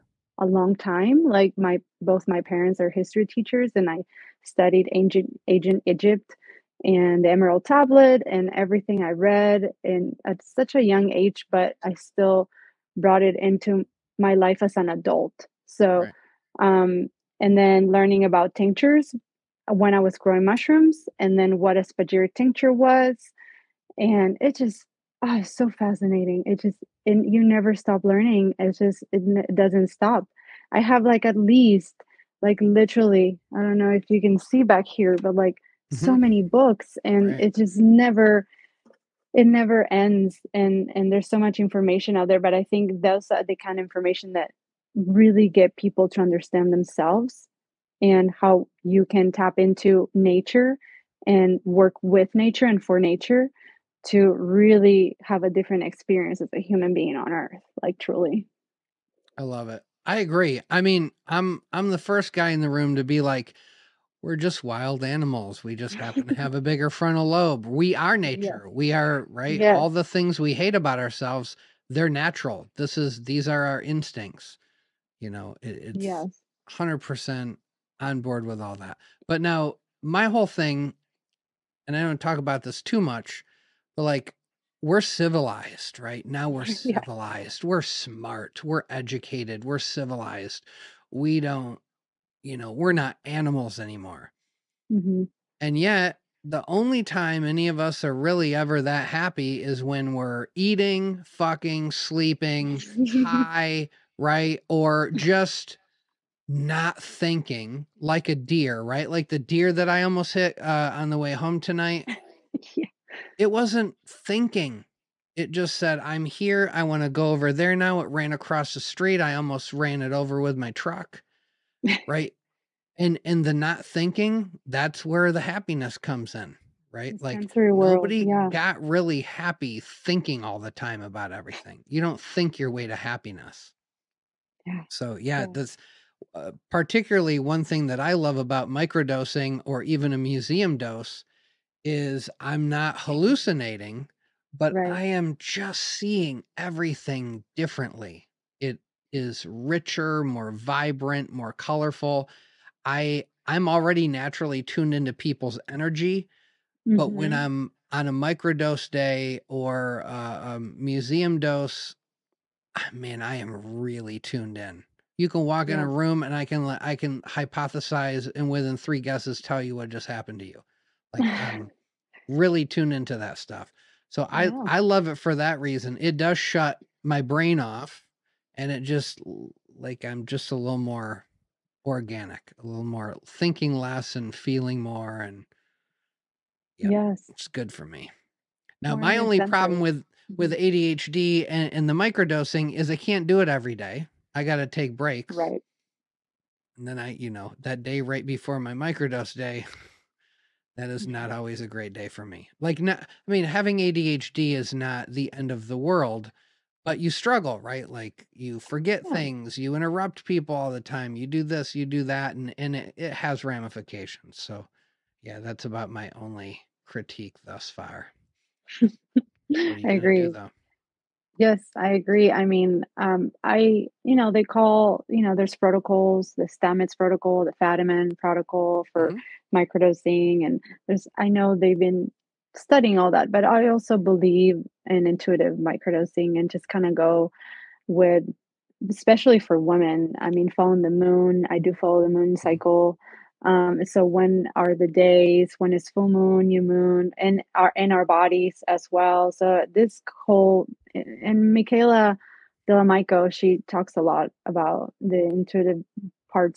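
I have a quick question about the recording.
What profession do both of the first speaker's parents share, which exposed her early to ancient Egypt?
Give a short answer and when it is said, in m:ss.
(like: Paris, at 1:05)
History teachers, at 0:02.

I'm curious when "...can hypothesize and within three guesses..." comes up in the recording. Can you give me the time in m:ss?
2:46.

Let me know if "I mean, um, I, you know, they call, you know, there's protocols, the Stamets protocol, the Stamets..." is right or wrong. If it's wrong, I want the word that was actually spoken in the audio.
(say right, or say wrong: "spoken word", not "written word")
wrong: "Fadiman", not "Stamets".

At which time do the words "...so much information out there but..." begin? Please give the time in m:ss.
0:41.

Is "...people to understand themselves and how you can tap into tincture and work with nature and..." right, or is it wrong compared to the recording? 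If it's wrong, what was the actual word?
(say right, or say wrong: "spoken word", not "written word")
wrong: "nature", not "tincture".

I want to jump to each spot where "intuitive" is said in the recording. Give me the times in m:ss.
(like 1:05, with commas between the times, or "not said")
3:55, 4:15.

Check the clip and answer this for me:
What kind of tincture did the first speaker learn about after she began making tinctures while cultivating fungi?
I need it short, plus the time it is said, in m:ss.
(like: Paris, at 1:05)
Spagyric tincture, at 0:21.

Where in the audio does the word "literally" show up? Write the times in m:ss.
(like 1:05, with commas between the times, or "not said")
0:32.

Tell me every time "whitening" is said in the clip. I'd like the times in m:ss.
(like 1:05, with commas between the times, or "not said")
not said.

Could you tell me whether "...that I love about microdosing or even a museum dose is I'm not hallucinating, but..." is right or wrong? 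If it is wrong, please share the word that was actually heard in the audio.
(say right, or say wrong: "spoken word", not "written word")
right.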